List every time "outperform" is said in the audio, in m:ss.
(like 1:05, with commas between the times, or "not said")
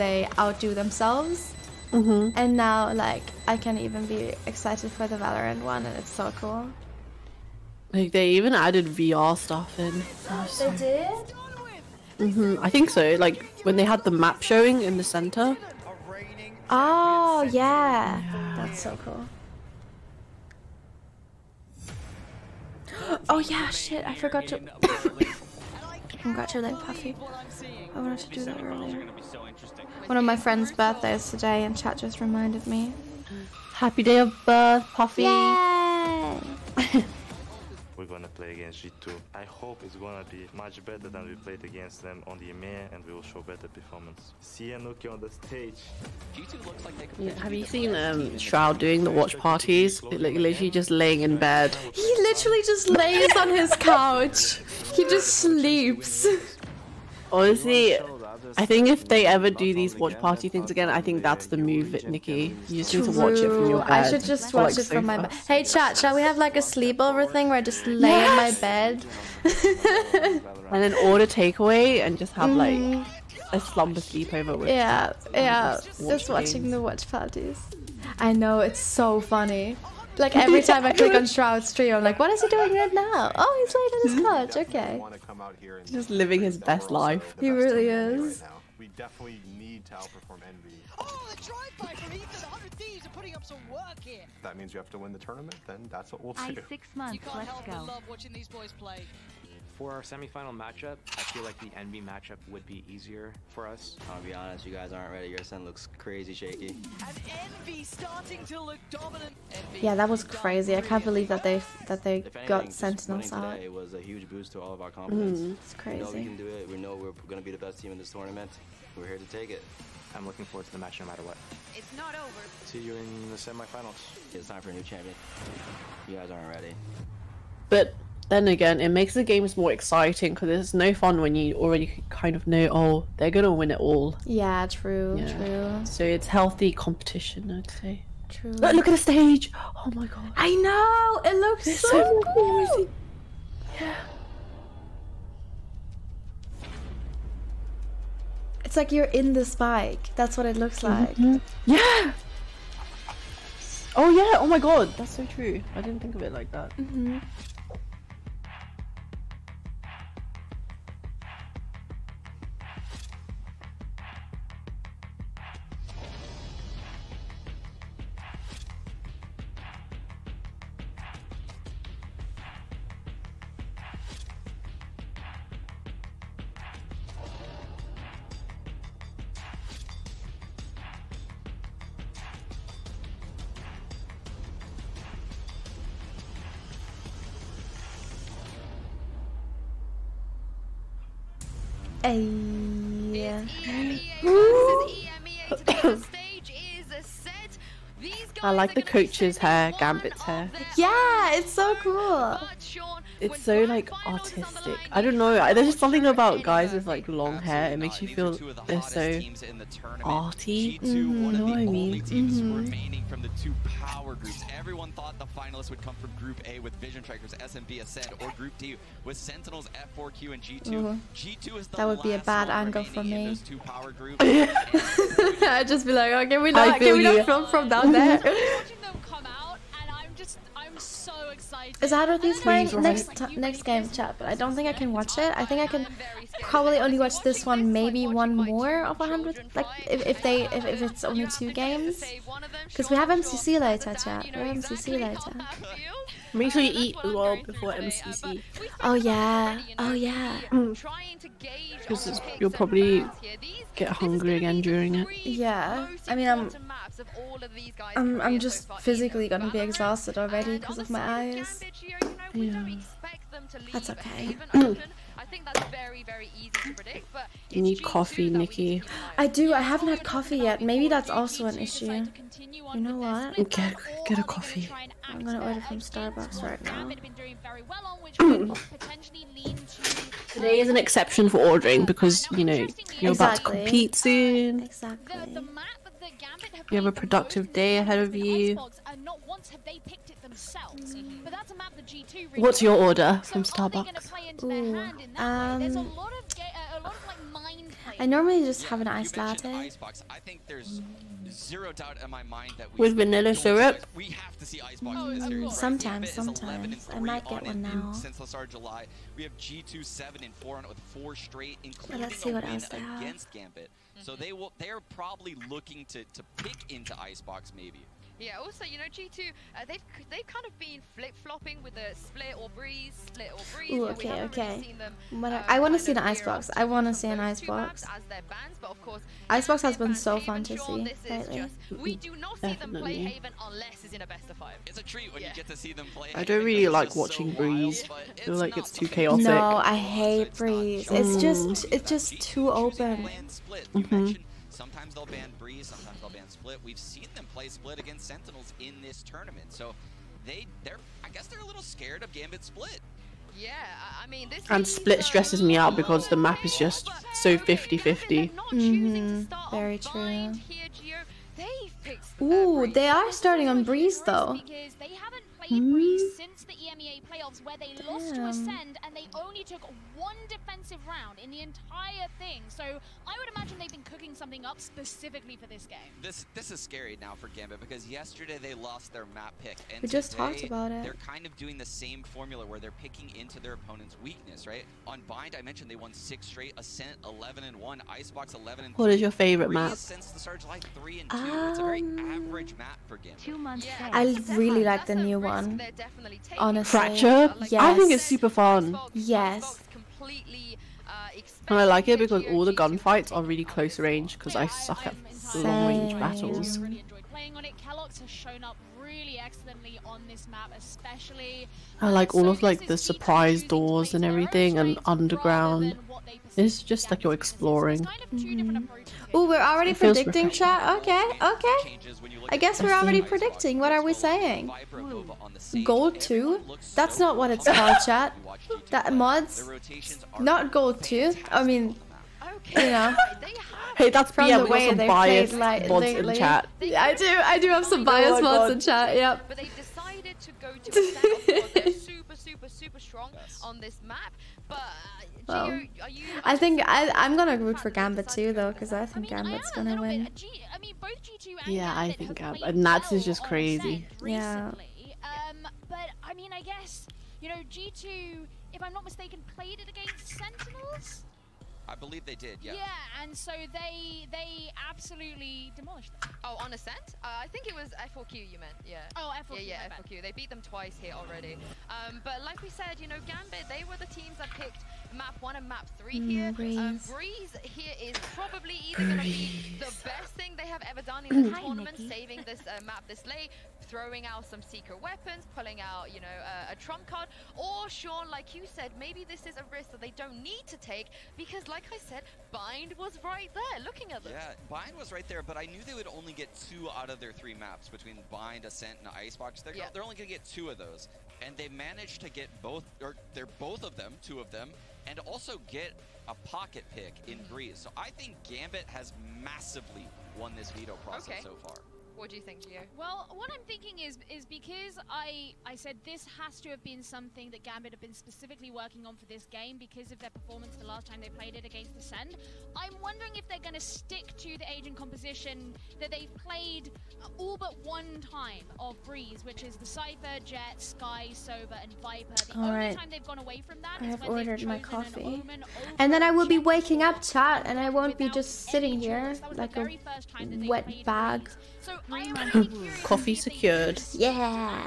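1:29.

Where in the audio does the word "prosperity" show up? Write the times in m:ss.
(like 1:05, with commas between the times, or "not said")
not said.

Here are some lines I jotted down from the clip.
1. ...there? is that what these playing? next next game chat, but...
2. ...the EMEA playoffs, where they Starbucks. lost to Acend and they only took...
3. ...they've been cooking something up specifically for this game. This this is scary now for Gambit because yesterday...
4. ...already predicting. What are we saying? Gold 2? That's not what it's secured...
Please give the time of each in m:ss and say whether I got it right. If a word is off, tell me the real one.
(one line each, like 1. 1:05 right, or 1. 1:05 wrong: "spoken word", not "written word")
1. 3:47 right
2. 6:06 wrong: "Damn", not "Starbucks"
3. 6:13 right
4. 7:02 wrong: "called", not "secured".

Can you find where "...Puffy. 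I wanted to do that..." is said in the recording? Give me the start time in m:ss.
0:26.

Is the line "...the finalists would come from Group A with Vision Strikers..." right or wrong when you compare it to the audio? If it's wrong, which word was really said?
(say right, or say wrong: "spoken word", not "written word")
right.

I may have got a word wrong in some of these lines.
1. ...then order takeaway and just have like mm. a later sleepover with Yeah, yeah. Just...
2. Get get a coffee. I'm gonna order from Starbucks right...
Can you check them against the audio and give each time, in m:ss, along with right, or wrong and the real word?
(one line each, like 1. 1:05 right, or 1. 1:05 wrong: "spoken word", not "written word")
1. 1:10 wrong: "slumber", not "later"
2. 4:33 right.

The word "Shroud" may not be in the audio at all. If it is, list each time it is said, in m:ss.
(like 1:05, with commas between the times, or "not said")
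0:48, 1:21.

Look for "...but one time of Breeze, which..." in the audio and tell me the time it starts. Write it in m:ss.
8:47.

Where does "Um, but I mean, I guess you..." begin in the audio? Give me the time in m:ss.
7:35.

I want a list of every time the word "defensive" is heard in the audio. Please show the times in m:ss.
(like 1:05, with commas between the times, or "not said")
6:10.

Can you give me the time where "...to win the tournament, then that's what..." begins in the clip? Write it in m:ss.
1:34.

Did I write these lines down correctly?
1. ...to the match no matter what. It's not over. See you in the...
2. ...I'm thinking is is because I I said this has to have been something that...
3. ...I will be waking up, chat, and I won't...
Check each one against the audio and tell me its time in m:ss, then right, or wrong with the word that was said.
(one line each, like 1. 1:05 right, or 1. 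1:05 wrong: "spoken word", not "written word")
1. 2:00 right
2. 8:33 right
3. 8:56 right.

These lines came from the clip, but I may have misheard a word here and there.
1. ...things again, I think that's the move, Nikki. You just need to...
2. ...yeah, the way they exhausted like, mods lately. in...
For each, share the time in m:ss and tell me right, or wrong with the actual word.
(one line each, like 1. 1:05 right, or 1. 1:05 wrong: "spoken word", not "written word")
1. 1:00 right
2. 7:14 wrong: "biased", not "exhausted".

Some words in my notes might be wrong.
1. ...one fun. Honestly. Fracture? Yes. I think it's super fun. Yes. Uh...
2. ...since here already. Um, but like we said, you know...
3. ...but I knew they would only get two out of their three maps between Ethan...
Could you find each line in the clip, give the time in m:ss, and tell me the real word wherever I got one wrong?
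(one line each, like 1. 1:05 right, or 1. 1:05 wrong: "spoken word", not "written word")
1. 6:35 right
2. 7:50 wrong: "twice", not "since"
3. 8:15 wrong: "Bind", not "Ethan".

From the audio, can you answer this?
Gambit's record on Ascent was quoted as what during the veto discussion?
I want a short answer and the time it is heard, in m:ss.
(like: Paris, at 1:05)
11 and 1, at 6:27.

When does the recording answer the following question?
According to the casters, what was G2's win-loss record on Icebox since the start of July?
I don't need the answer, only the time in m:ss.
5:09.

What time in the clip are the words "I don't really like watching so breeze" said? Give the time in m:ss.
5:36.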